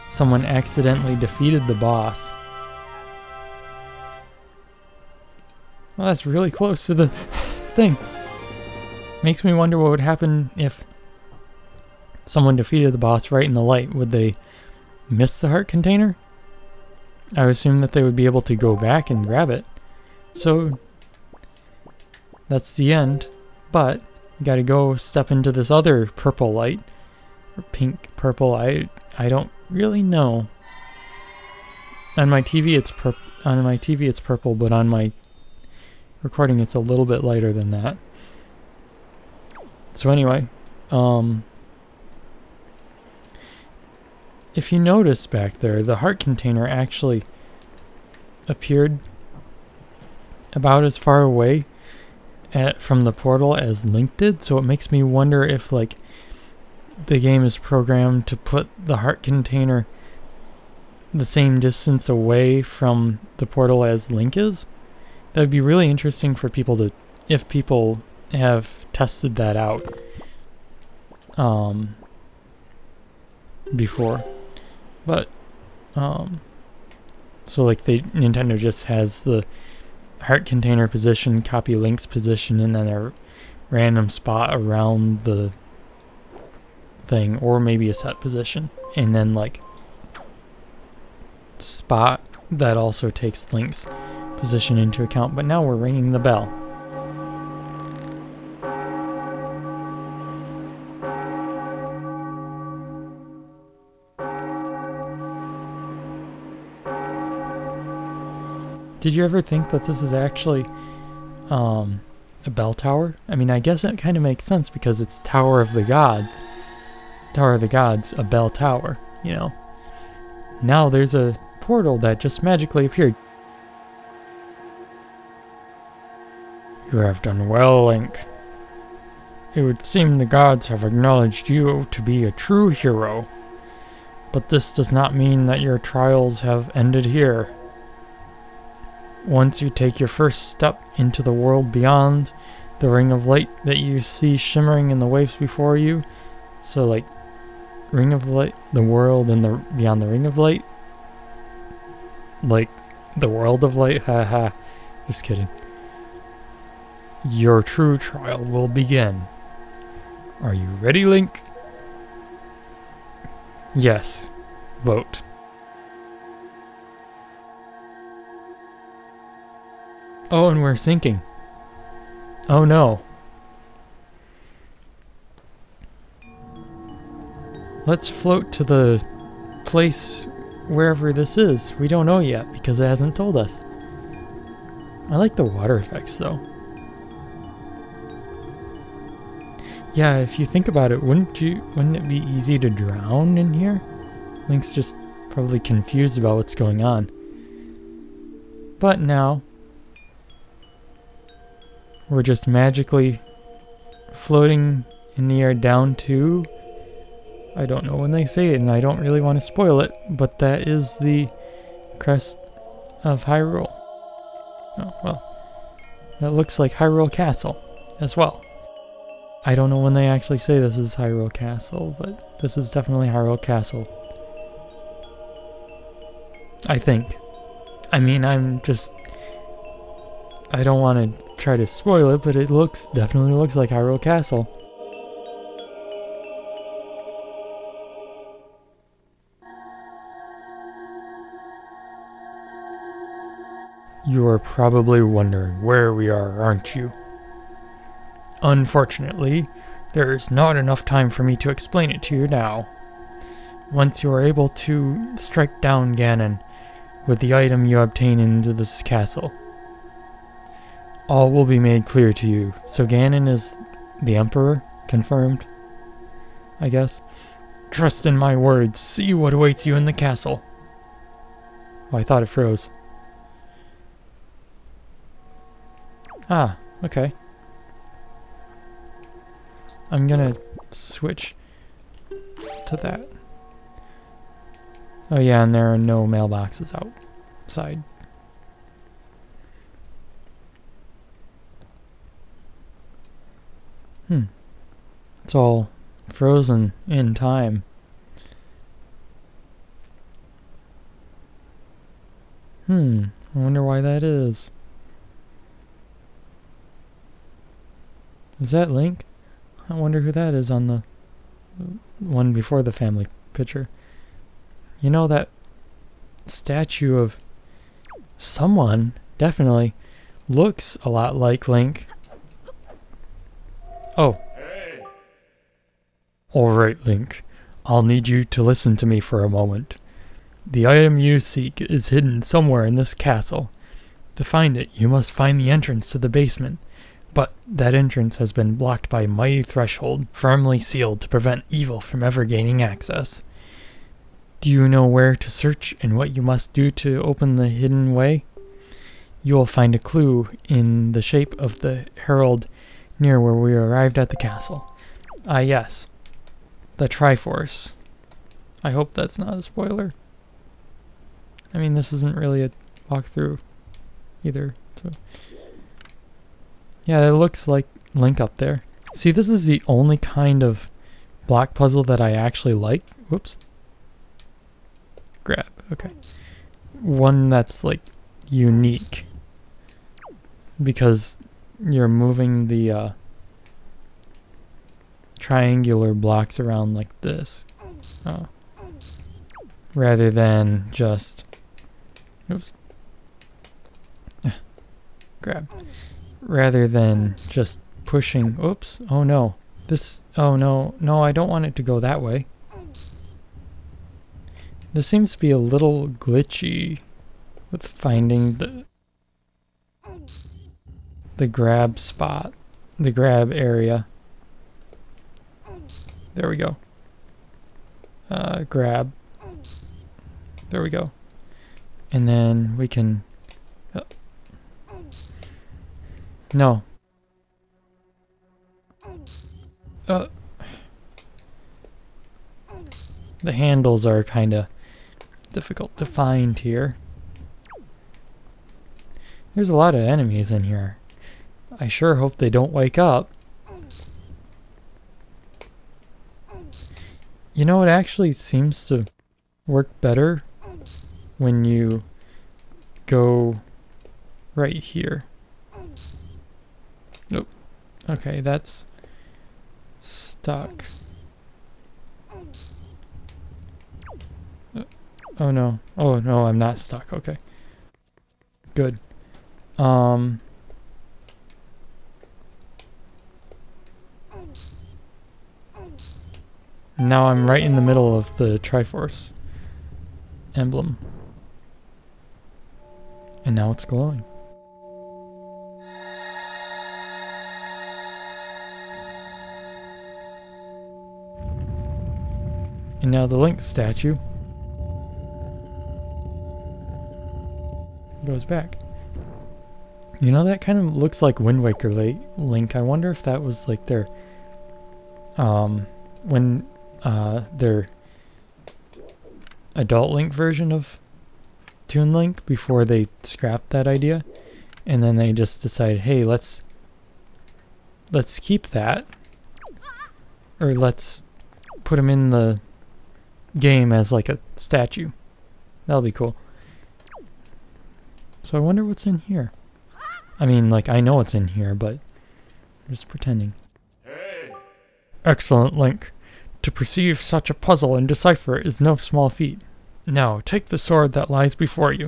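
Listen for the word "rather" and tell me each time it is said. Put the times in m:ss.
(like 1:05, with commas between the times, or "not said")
6:29, 6:36.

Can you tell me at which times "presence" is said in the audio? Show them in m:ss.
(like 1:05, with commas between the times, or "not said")
not said.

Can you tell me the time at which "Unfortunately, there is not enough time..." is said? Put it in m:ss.
4:08.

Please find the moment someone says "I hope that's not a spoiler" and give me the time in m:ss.
5:58.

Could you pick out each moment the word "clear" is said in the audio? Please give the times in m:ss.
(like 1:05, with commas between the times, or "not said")
4:21.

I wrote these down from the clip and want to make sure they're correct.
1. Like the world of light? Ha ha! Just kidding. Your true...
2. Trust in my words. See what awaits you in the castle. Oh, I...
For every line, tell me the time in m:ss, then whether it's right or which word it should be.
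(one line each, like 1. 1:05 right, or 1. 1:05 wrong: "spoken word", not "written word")
1. 2:32 right
2. 4:27 right.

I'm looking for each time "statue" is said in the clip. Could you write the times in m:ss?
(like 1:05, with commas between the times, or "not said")
5:16, 8:13, 8:44.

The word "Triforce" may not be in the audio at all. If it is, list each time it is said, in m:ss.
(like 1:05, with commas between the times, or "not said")
5:56, 7:58.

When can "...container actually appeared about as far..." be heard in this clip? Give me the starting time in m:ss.
0:46.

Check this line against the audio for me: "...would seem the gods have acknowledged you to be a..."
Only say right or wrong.
right.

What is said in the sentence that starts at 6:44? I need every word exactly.
This seems to be a little glitchy with finding the the grab spot, the grab area.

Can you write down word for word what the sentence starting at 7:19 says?
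There's a lot of enemies in here.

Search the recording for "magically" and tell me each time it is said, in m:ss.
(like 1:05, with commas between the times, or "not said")
2:02, 3:22.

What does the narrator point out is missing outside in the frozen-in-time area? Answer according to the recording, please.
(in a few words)
Mailboxes.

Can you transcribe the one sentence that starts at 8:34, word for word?
And then they just decided, hey, let's, let's keep that.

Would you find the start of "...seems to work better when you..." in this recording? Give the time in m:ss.
7:28.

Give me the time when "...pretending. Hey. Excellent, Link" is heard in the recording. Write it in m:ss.
8:52.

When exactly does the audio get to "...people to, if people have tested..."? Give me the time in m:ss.
1:06.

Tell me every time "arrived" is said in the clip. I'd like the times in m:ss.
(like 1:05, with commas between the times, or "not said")
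5:53.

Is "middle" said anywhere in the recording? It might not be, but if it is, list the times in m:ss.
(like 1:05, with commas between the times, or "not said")
7:57.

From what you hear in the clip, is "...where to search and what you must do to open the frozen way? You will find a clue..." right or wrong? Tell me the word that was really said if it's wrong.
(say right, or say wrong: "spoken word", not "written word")
wrong: "hidden", not "frozen".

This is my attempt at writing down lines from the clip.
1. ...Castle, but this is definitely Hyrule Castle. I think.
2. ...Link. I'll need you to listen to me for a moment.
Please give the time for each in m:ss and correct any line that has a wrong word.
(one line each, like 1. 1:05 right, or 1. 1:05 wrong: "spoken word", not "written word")
1. 3:41 right
2. 5:26 right.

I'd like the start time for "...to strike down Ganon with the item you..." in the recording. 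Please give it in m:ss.
4:14.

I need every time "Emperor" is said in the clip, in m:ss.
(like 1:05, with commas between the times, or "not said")
4:24.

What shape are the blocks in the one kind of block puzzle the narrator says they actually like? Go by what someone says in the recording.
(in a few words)
Triangular.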